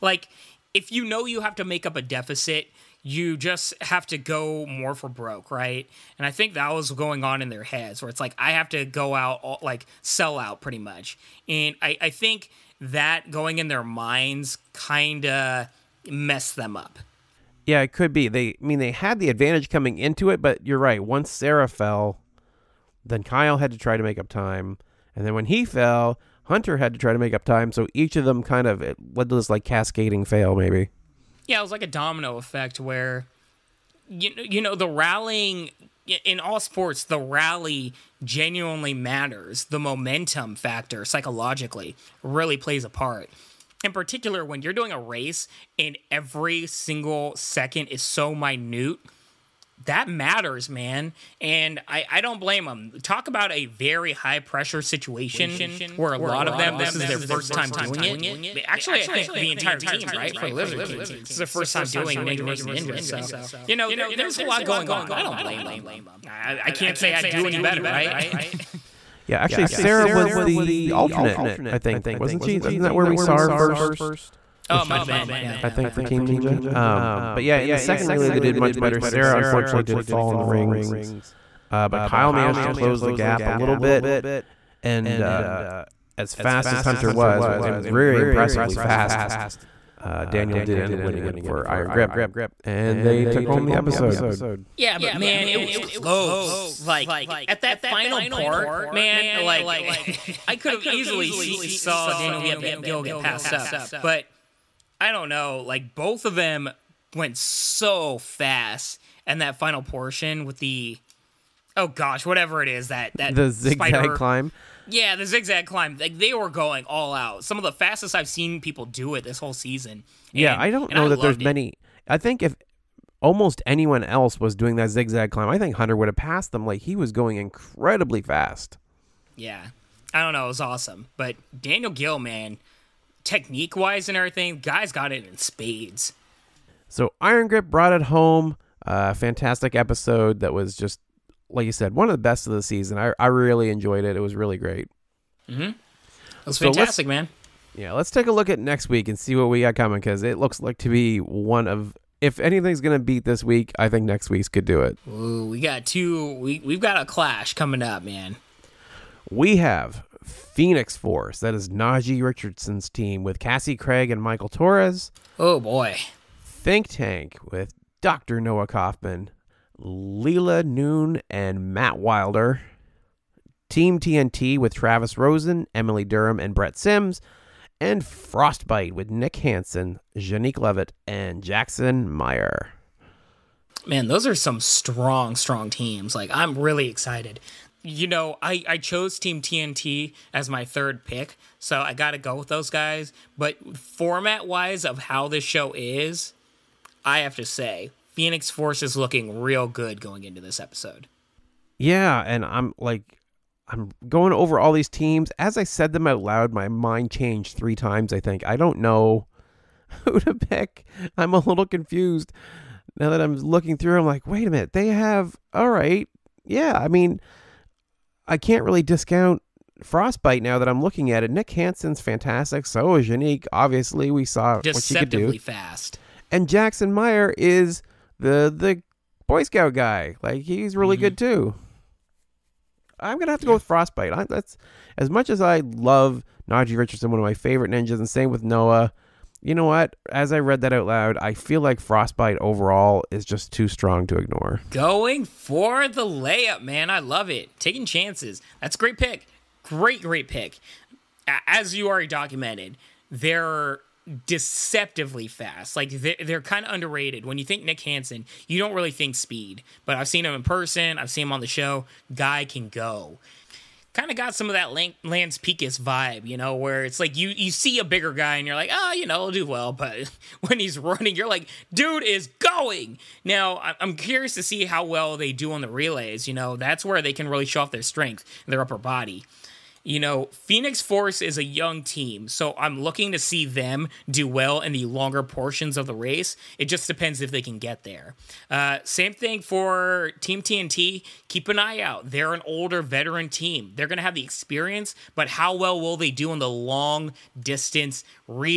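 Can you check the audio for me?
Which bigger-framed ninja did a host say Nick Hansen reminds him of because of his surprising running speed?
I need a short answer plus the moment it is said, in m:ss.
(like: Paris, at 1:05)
Lance Pekus, at 4:24.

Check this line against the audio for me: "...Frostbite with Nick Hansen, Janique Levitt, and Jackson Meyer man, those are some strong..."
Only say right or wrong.
right.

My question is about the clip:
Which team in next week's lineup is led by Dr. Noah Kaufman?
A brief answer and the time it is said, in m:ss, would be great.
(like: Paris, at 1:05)
Think Tank, at 2:46.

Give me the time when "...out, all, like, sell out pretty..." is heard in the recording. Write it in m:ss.
0:09.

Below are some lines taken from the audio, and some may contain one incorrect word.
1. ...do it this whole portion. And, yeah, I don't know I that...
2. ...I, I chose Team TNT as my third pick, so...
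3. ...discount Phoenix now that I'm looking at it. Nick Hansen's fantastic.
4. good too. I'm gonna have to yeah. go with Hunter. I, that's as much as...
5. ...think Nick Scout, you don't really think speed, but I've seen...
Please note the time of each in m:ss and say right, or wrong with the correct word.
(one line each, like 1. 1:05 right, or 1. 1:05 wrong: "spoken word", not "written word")
1. 1:58 wrong: "season", not "portion"
2. 3:08 right
3. 3:38 wrong: "Frostbite", not "Phoenix"
4. 3:51 wrong: "Frostbite", not "Hunter"
5. 4:17 wrong: "Hansen", not "Scout".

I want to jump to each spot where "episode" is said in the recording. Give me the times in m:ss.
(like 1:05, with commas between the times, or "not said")
1:33, 2:19, 3:20.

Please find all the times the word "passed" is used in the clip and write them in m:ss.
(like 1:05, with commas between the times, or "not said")
1:43, 2:06.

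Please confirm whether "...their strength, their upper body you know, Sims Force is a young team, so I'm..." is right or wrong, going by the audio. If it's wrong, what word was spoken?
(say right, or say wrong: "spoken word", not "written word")
wrong: "Phoenix", not "Sims".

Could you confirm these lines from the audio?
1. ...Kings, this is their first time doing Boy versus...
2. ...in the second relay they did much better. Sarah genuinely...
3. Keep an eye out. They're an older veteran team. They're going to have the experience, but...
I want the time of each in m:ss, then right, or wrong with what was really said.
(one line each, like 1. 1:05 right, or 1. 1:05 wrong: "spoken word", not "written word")
1. 1:00 wrong: "Ninja", not "Boy"
2. 1:17 wrong: "unfortunately", not "genuinely"
3. 4:51 right.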